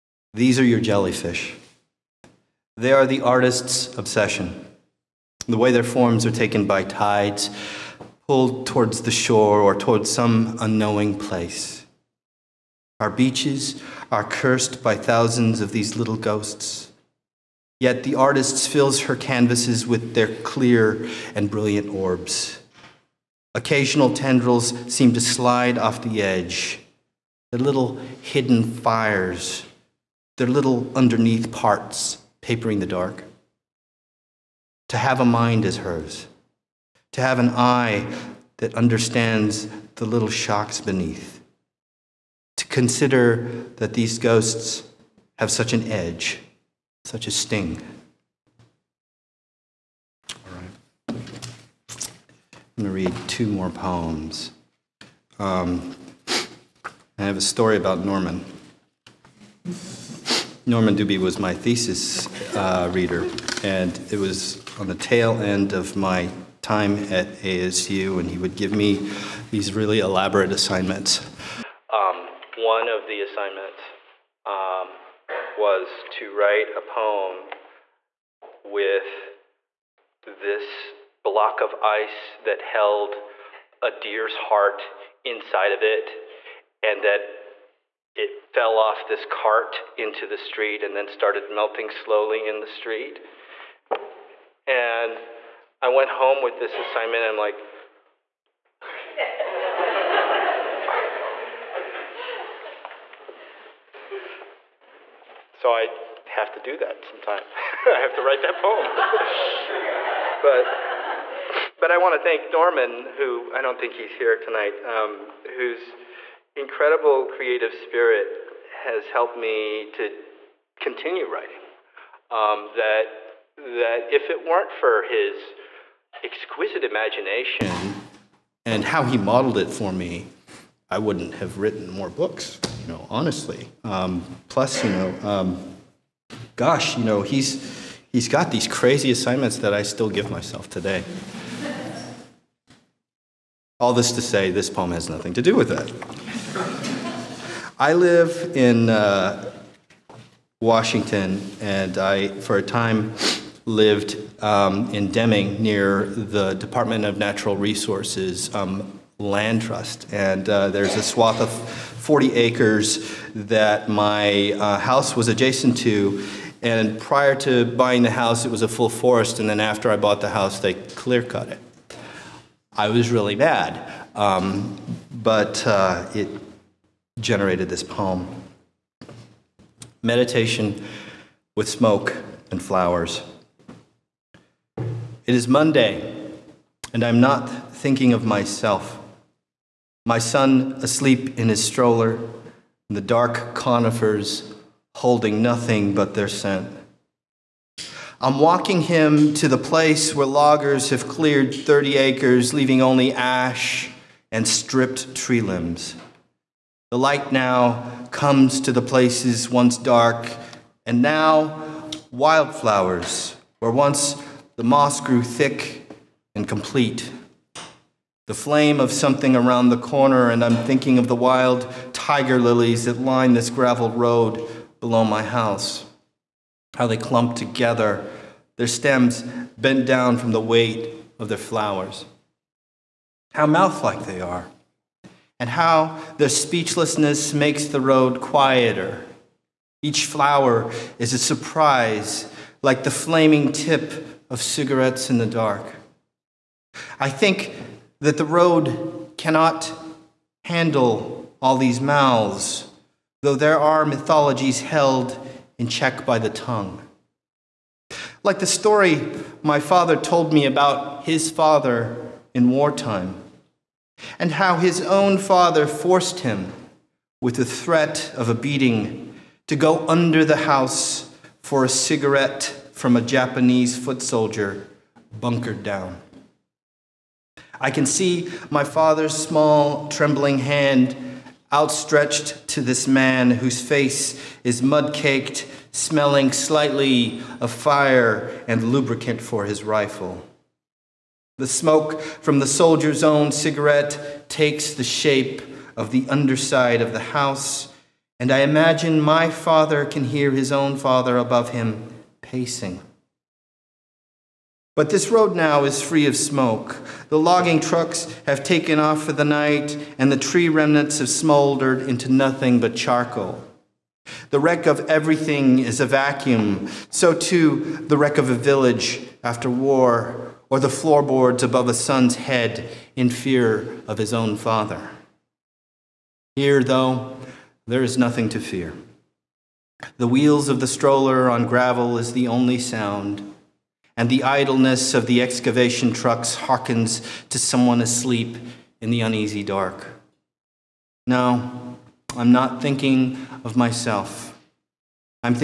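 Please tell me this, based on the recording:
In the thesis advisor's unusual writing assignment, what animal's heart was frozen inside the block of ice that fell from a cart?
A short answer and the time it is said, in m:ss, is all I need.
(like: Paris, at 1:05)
Deer, at 1:23.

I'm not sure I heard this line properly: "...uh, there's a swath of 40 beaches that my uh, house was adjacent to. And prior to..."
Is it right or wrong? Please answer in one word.
wrong.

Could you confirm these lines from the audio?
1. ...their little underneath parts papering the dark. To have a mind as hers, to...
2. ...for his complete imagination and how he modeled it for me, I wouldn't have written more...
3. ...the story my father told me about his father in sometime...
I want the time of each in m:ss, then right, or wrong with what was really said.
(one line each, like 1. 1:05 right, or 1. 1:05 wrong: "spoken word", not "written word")
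1. 0:30 right
2. 2:04 wrong: "exquisite", not "complete"
3. 4:18 wrong: "wartime", not "sometime".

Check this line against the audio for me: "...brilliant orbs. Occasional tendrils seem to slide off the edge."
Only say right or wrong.
right.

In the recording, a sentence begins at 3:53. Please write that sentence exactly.
How mouth like they are, and how their speechlessness makes the road quieter.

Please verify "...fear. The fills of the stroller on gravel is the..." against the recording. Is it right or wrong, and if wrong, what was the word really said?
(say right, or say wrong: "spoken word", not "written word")
wrong: "wheels", not "fills".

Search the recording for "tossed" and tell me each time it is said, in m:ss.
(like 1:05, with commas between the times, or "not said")
not said.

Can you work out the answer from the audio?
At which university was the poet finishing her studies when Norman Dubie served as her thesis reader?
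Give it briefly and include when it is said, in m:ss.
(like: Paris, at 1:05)
ASU, at 1:07.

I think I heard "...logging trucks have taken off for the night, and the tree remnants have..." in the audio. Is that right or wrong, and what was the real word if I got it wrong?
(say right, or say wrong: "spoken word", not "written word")
right.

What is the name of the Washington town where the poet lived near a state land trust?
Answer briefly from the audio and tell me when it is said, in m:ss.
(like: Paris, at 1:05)
Deming, at 2:35.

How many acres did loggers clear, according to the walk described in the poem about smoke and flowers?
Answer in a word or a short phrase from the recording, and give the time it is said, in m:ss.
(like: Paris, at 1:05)
30, at 3:21.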